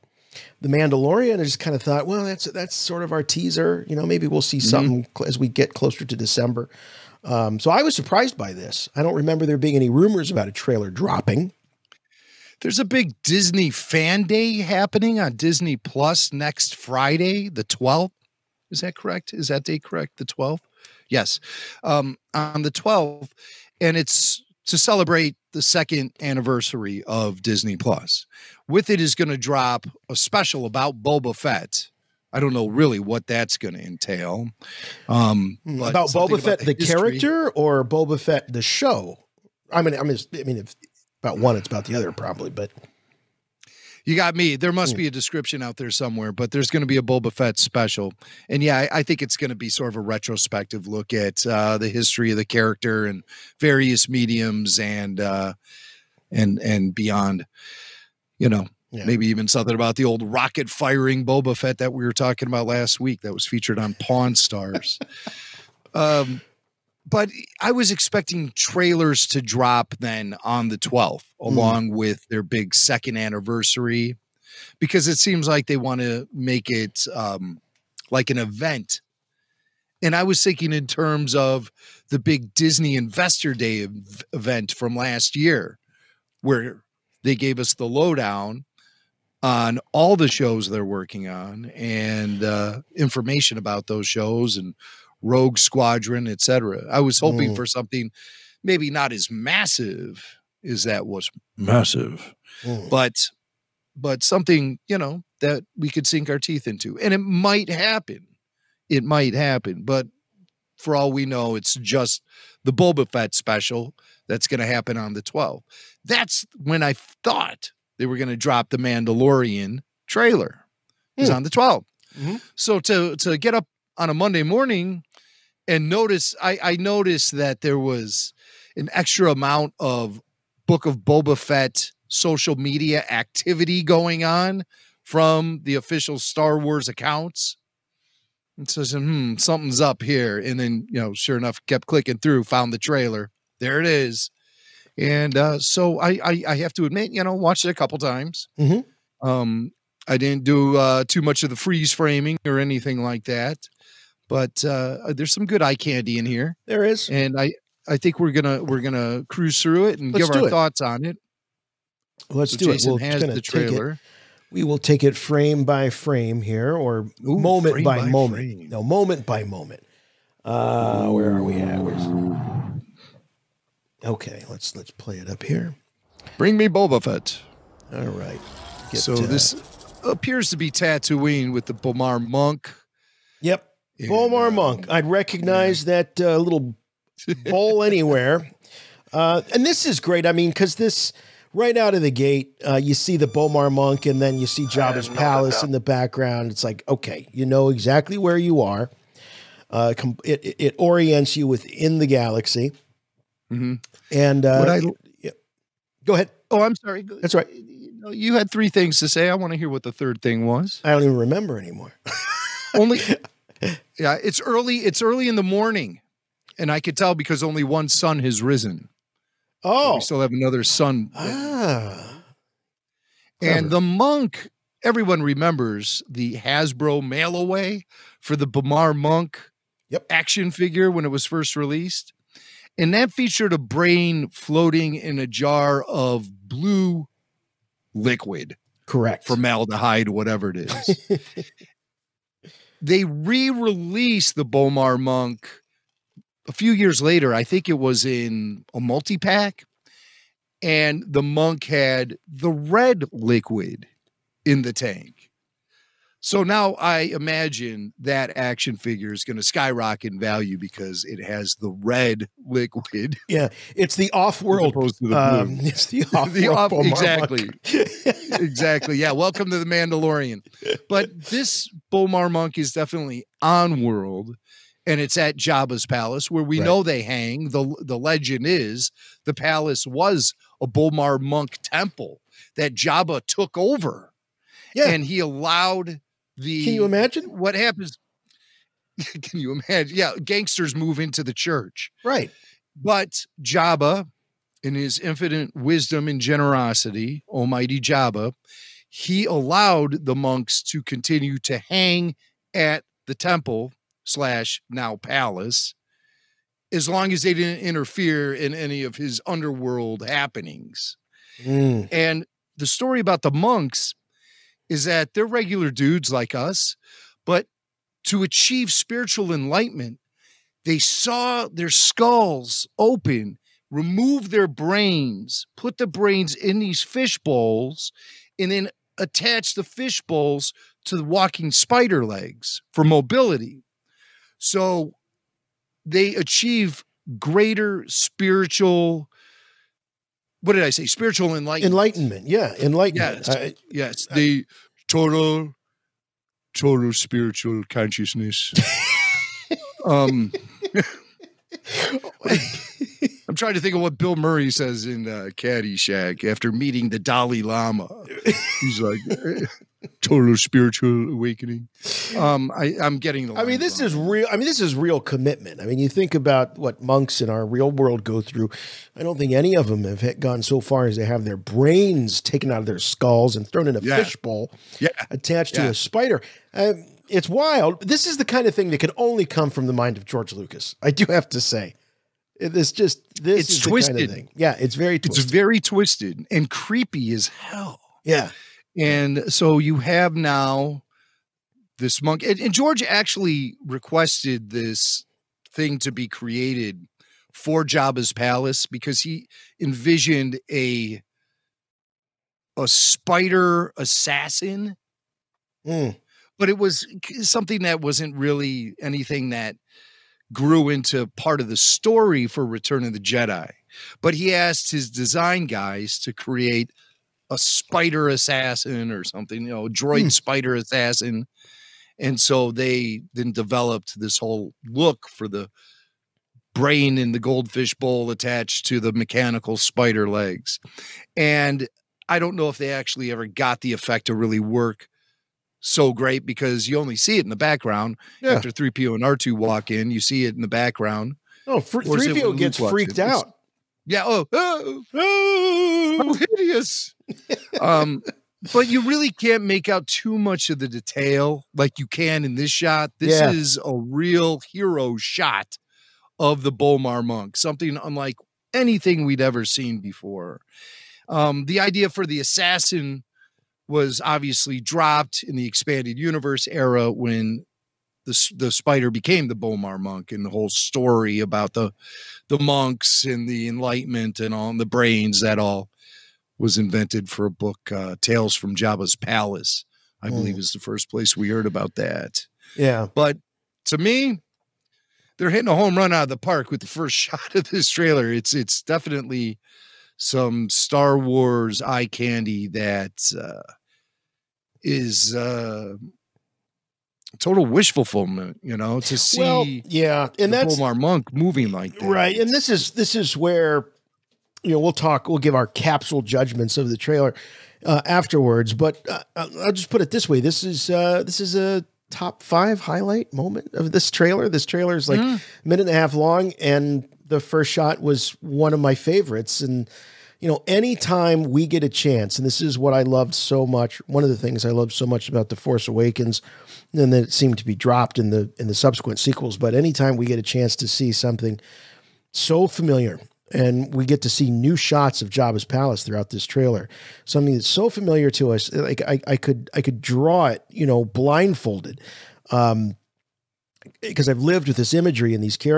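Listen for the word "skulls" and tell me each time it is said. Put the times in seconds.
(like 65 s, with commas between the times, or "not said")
321 s, 372 s.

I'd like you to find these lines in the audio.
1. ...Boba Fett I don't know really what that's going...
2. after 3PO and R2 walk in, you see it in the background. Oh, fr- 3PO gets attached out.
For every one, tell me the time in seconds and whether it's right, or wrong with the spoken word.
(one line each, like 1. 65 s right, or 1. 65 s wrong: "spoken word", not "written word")
1. 31 s right
2. 438 s wrong: "freaked", not "attached".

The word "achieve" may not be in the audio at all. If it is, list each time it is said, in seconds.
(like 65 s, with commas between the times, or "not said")
318 s, 336 s.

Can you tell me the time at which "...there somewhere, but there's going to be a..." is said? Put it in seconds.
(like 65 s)
45 s.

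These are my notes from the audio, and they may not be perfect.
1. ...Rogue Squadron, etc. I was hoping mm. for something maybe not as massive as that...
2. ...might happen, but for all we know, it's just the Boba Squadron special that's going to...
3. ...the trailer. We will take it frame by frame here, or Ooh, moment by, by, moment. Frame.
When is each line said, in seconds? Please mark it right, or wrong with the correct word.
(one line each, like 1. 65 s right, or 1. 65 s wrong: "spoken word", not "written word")
1. 95 s right
2. 109 s wrong: "Fett", not "Squadron"
3. 163 s right.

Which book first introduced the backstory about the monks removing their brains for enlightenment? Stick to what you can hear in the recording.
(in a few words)
Tales from Jabba's Palace.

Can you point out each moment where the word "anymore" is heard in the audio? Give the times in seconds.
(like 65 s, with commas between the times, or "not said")
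211 s.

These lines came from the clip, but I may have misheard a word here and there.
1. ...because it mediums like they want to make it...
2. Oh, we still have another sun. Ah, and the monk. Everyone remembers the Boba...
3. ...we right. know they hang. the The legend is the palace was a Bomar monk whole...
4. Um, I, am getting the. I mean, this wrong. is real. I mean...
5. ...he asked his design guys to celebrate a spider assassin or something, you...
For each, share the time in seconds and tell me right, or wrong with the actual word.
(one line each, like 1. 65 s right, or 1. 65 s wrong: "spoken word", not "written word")
1. 74 s wrong: "seems", not "mediums"
2. 219 s wrong: "Hasbro", not "Boba"
3. 276 s wrong: "temple", not "whole"
4. 362 s right
5. 414 s wrong: "create", not "celebrate".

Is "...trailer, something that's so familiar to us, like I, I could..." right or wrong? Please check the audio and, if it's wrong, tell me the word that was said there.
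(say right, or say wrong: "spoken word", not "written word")
right.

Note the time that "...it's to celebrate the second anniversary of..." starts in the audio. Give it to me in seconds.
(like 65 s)
23 s.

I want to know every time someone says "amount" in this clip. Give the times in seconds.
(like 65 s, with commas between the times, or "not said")
129 s.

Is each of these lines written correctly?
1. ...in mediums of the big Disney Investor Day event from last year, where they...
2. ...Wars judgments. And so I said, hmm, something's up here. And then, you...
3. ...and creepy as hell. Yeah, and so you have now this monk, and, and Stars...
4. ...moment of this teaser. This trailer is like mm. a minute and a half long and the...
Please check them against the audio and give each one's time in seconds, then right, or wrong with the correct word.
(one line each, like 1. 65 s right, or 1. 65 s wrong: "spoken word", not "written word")
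1. 80 s wrong: "terms", not "mediums"
2. 136 s wrong: "accounts", not "judgments"
3. 386 s wrong: "George", not "Stars"
4. 513 s wrong: "trailer", not "teaser".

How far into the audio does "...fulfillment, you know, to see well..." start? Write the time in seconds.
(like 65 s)
497 s.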